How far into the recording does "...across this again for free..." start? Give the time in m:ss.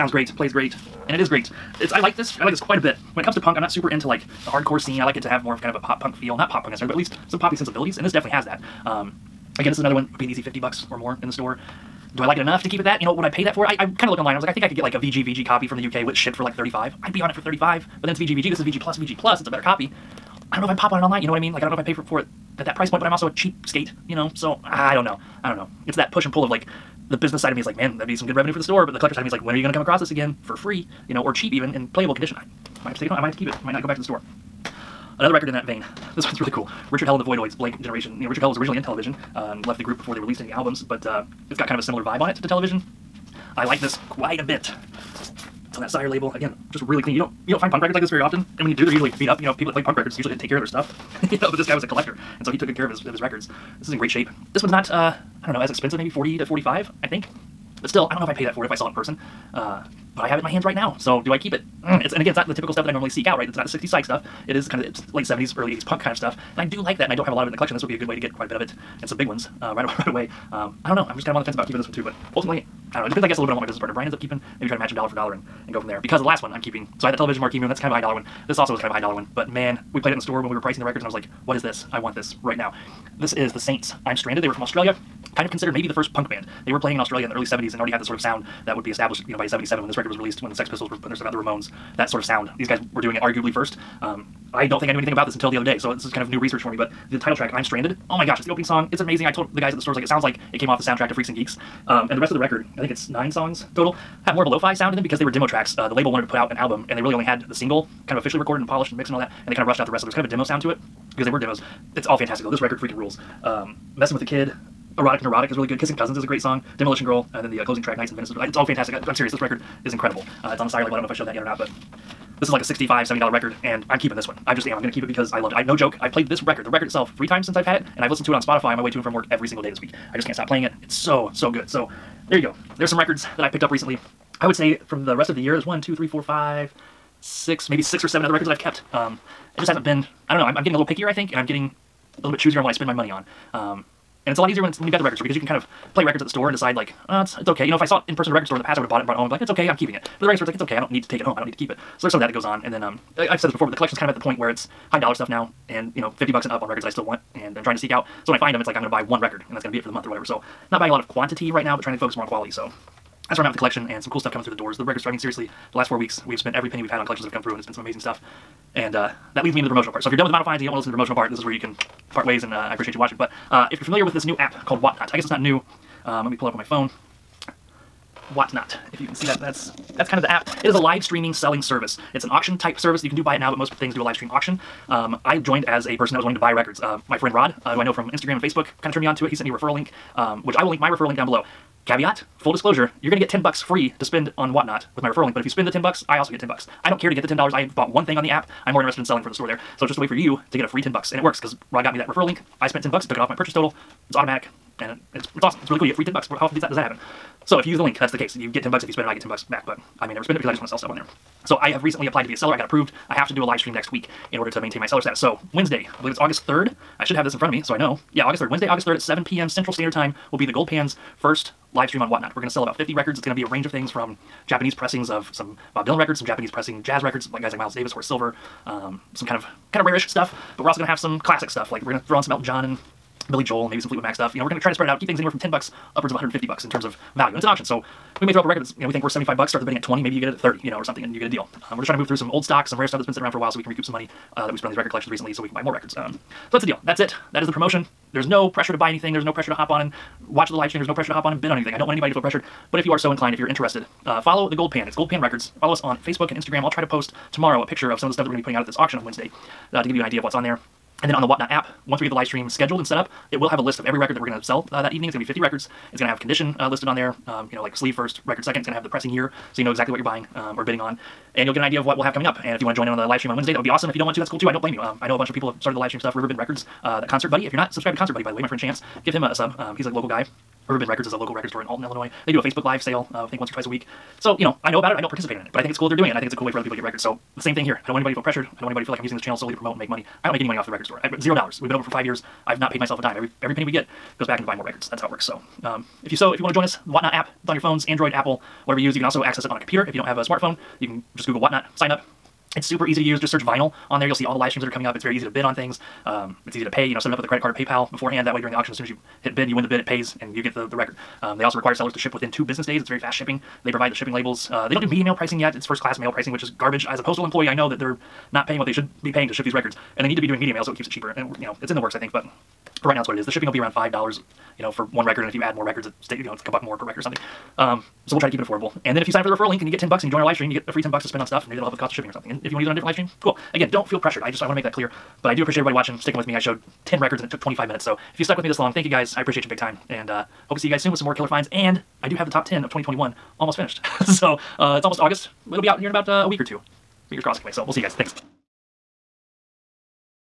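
0:29.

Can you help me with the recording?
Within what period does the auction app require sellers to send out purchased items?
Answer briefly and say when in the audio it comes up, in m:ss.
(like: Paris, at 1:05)
2 business days, at 5:12.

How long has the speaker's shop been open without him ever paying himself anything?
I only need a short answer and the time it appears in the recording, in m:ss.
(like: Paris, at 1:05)
5 years, at 4:51.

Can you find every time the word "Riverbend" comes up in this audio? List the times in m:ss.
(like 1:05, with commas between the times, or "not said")
4:36, 4:40.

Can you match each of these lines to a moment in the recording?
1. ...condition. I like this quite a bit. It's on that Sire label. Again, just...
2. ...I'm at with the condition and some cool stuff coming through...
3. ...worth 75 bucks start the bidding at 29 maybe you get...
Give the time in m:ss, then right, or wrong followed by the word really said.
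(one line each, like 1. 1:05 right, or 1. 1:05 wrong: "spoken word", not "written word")
1. 0:42 wrong: "television", not "condition"
2. 2:43 wrong: "collection", not "condition"
3. 3:59 wrong: "20", not "29".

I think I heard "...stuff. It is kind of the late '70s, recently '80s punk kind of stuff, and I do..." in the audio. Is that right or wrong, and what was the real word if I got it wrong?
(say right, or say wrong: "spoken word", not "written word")
wrong: "early", not "recently".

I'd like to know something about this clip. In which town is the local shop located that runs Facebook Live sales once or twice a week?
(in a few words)
Alton, Illinois.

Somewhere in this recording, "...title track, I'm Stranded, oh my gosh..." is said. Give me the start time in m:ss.
1:37.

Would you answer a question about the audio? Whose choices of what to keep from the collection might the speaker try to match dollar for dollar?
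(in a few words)
Brian.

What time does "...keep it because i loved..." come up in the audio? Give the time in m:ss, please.
2:04.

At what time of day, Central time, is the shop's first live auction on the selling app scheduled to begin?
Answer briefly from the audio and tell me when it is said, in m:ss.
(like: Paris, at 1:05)
7 p.m., at 3:39.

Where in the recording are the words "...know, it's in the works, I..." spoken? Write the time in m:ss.
5:21.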